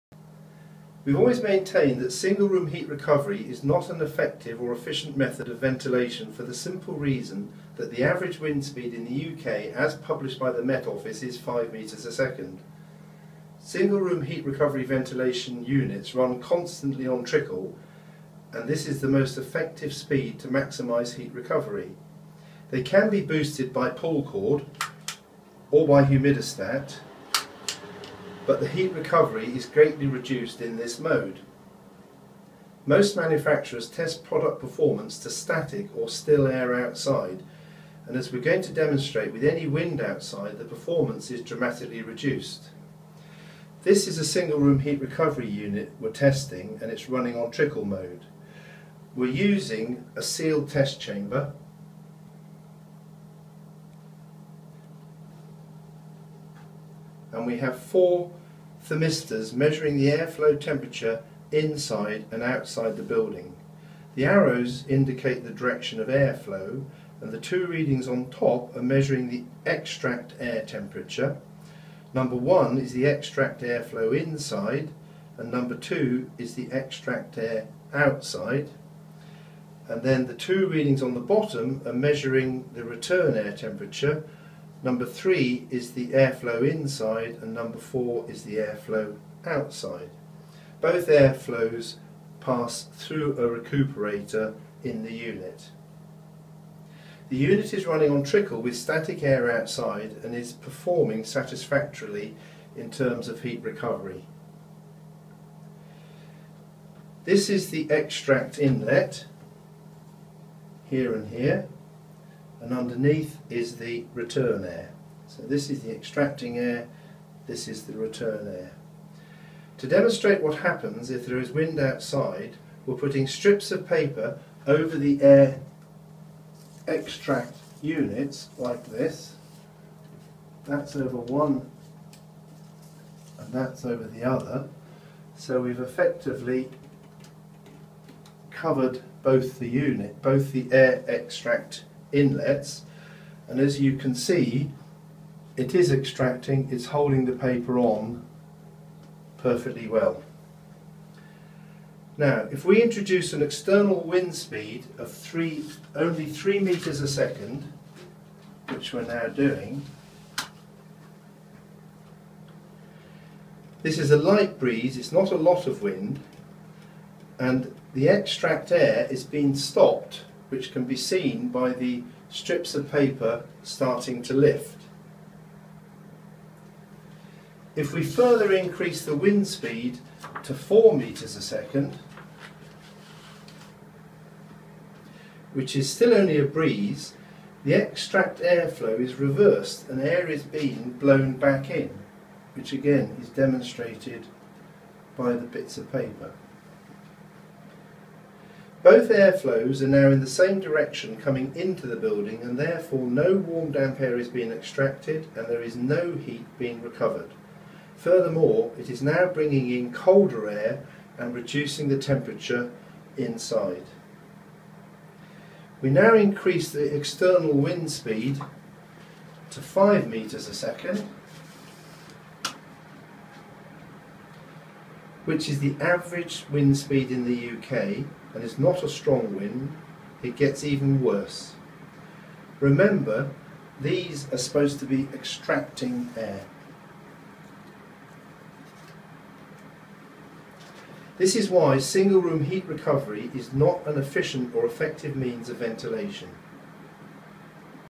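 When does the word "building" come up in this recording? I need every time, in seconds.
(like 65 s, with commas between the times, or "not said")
63 s, 201 s.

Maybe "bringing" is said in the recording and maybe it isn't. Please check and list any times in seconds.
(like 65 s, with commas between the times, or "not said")
209 s.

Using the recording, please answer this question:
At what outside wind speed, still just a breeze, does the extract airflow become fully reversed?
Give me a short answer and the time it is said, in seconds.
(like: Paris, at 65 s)
4 metres a second, at 180 s.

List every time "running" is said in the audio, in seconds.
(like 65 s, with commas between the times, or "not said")
47 s, 97 s.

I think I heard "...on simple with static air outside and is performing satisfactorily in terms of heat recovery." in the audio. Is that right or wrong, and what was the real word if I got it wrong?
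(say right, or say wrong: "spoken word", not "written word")
wrong: "trickle", not "simple".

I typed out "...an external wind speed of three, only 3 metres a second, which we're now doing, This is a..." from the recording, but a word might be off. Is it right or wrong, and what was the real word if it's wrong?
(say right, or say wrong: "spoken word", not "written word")
right.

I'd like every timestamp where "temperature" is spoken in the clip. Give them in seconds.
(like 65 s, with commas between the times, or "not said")
60 s, 70 s, 83 s, 211 s.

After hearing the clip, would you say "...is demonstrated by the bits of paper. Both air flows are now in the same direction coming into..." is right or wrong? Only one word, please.
right.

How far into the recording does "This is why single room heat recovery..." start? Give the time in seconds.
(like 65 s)
241 s.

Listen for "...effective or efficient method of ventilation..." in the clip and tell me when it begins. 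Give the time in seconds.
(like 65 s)
4 s.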